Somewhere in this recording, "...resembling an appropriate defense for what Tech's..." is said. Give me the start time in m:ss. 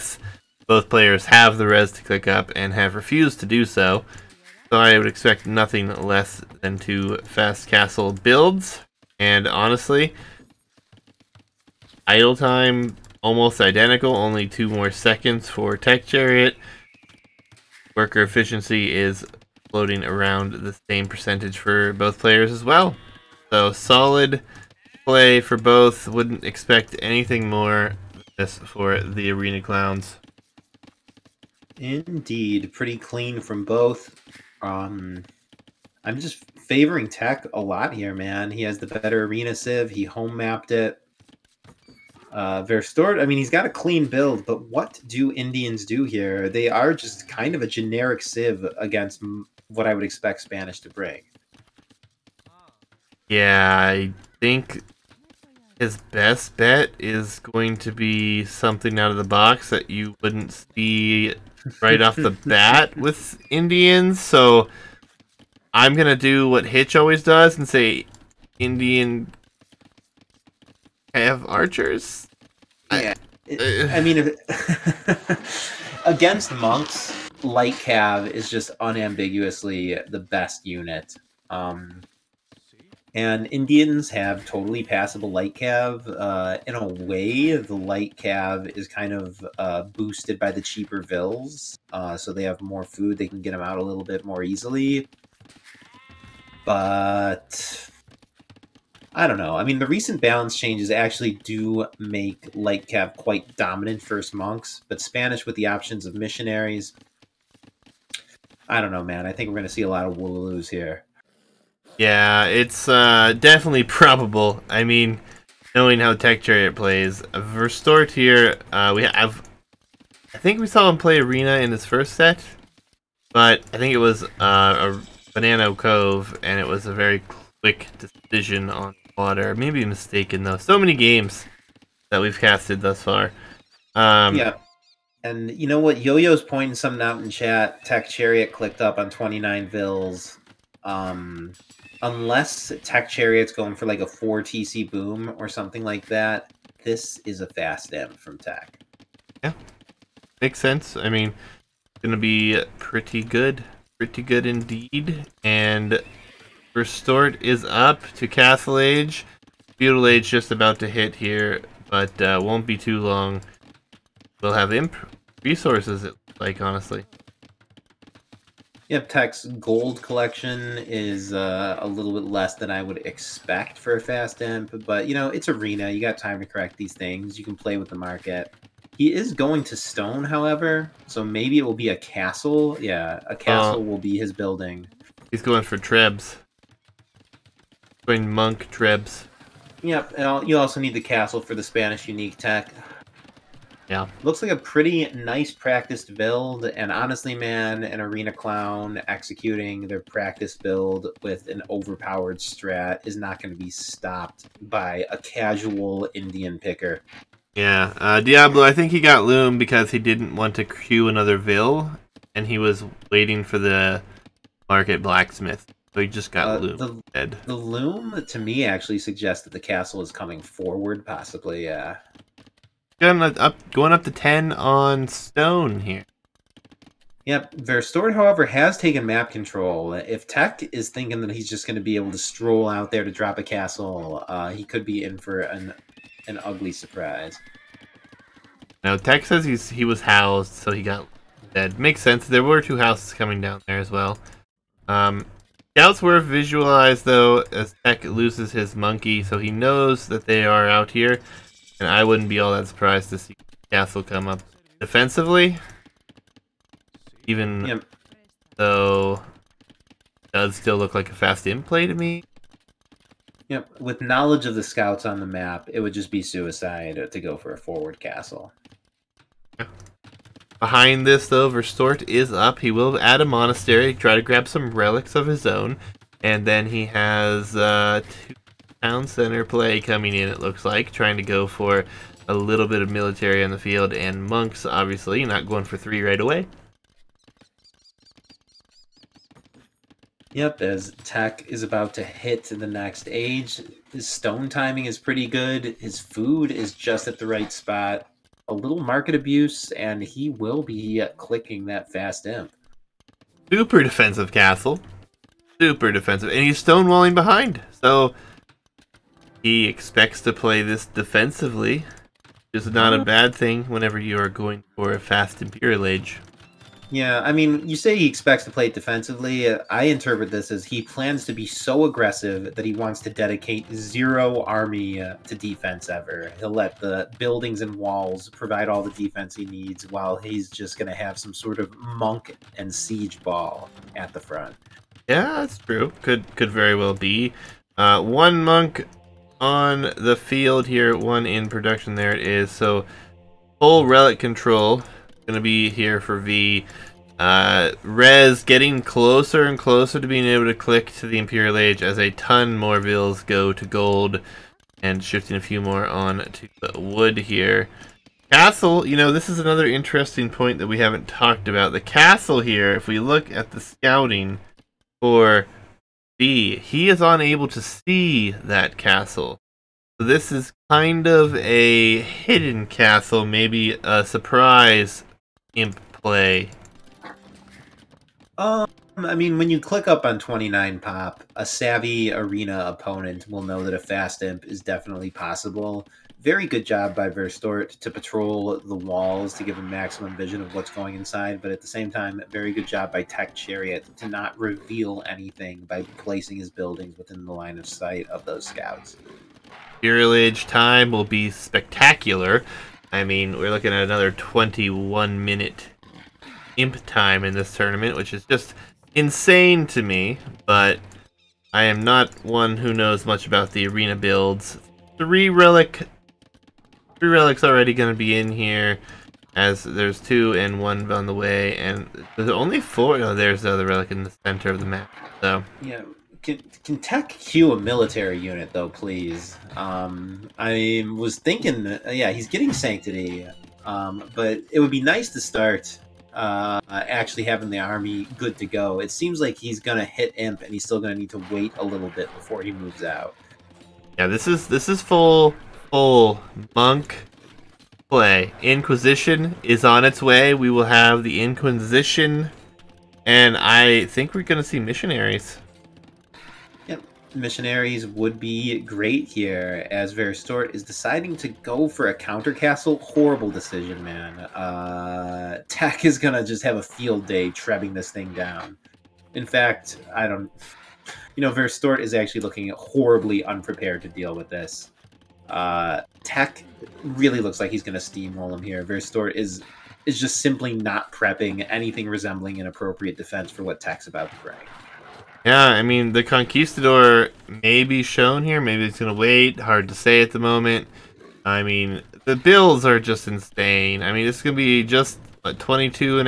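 8:01.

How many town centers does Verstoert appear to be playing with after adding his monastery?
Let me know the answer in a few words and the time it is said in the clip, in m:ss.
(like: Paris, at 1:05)
2, at 4:38.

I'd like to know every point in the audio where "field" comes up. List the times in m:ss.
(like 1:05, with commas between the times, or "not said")
4:43, 5:40, 7:46.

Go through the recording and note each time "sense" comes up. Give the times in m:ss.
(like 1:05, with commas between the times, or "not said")
2:30, 4:02.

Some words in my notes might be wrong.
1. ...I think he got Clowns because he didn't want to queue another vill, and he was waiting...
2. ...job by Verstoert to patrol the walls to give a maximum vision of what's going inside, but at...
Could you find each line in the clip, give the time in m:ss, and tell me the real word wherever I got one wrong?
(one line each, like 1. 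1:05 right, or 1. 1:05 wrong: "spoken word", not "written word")
1. 3:28 wrong: "Loom", not "Clowns"
2. 6:26 right.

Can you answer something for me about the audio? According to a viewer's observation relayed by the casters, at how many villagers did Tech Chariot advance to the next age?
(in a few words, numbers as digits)
29.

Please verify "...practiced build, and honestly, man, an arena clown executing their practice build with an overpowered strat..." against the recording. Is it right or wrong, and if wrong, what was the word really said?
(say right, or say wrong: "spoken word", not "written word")
right.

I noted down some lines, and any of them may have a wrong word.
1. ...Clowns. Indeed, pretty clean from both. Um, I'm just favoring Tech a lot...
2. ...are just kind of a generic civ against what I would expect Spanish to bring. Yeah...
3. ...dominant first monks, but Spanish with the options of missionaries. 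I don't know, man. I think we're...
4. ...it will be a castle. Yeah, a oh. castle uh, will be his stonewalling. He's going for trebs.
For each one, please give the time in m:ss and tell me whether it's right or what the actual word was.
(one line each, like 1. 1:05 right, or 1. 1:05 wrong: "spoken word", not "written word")
1. 0:29 right
2. 0:46 right
3. 1:43 right
4. 3:01 wrong: "building", not "stonewalling".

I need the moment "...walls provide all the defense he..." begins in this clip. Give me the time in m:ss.
5:27.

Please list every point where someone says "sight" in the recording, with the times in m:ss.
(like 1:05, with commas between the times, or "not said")
6:37.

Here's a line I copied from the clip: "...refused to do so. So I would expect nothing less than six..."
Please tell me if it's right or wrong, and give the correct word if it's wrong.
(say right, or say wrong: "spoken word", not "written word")
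wrong: "two", not "six".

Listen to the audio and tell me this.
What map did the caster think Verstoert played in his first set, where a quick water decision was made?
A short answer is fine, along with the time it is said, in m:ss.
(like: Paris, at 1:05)
Banana Cove, at 2:05.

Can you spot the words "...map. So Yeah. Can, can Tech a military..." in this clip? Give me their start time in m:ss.
7:04.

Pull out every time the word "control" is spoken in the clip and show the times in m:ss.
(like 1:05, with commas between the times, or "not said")
3:49, 5:44.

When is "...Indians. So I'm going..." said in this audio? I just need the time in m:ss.
1:03.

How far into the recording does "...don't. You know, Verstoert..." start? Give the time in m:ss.
7:50.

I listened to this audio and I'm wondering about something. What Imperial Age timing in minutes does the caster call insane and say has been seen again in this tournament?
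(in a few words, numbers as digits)
21 minutes.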